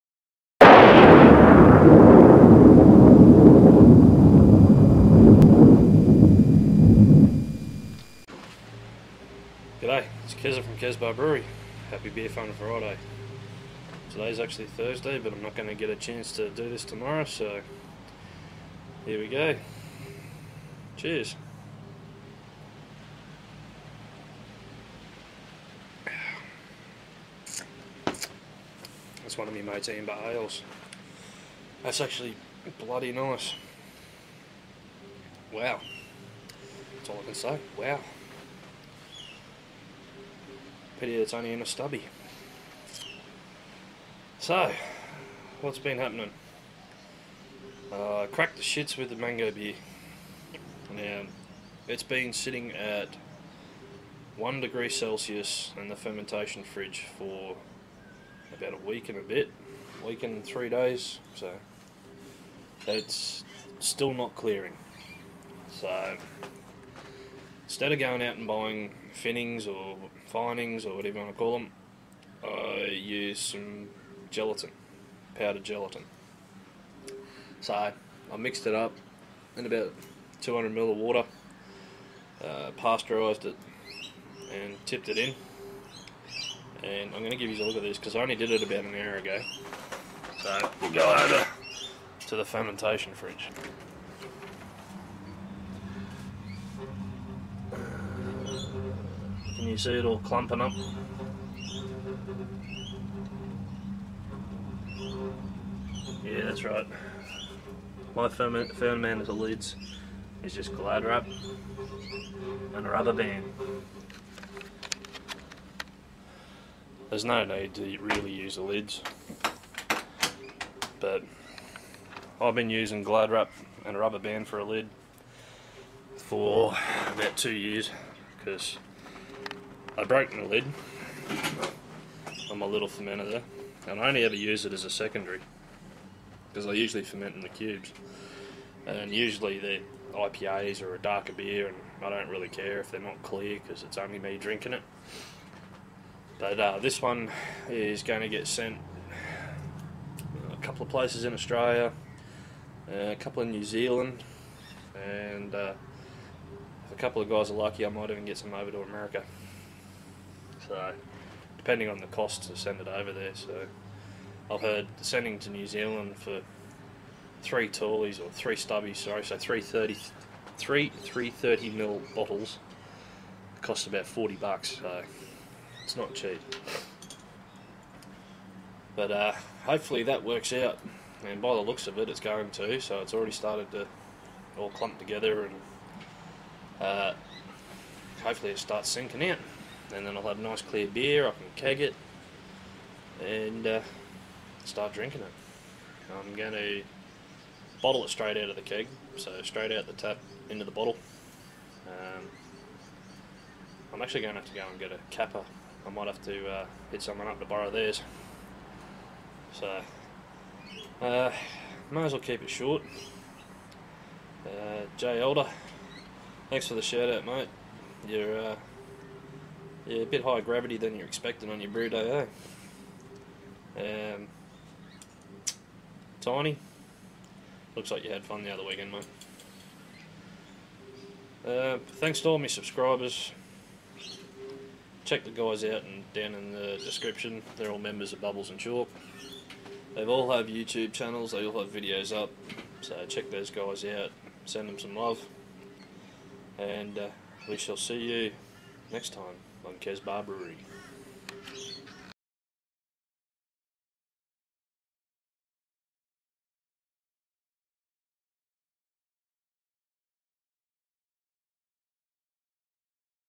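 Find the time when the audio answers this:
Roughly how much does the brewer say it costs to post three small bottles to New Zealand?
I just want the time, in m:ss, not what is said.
2:54.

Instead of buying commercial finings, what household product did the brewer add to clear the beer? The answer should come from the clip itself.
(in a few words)
Powdered gelatin.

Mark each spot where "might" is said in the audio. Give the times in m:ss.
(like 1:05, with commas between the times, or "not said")
2:37, 3:25, 3:31.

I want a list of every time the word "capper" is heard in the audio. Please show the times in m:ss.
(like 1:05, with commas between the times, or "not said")
3:25.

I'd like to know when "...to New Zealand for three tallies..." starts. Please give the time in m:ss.
2:45.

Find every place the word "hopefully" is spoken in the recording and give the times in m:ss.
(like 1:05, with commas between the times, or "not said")
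2:59, 3:08.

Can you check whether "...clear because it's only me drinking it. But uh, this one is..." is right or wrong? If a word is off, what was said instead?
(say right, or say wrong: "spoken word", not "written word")
right.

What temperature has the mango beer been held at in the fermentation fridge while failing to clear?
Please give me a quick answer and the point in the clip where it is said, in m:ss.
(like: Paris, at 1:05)
1 degree Celsius, at 0:54.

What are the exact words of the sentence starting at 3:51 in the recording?
Uh, thanks to all my subscribers.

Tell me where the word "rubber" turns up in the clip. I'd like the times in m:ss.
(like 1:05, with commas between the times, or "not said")
1:52, 2:03.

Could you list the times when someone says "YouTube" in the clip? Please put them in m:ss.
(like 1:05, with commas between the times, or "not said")
4:00.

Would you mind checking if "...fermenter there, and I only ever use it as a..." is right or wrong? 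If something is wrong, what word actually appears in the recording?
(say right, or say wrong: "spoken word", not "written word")
right.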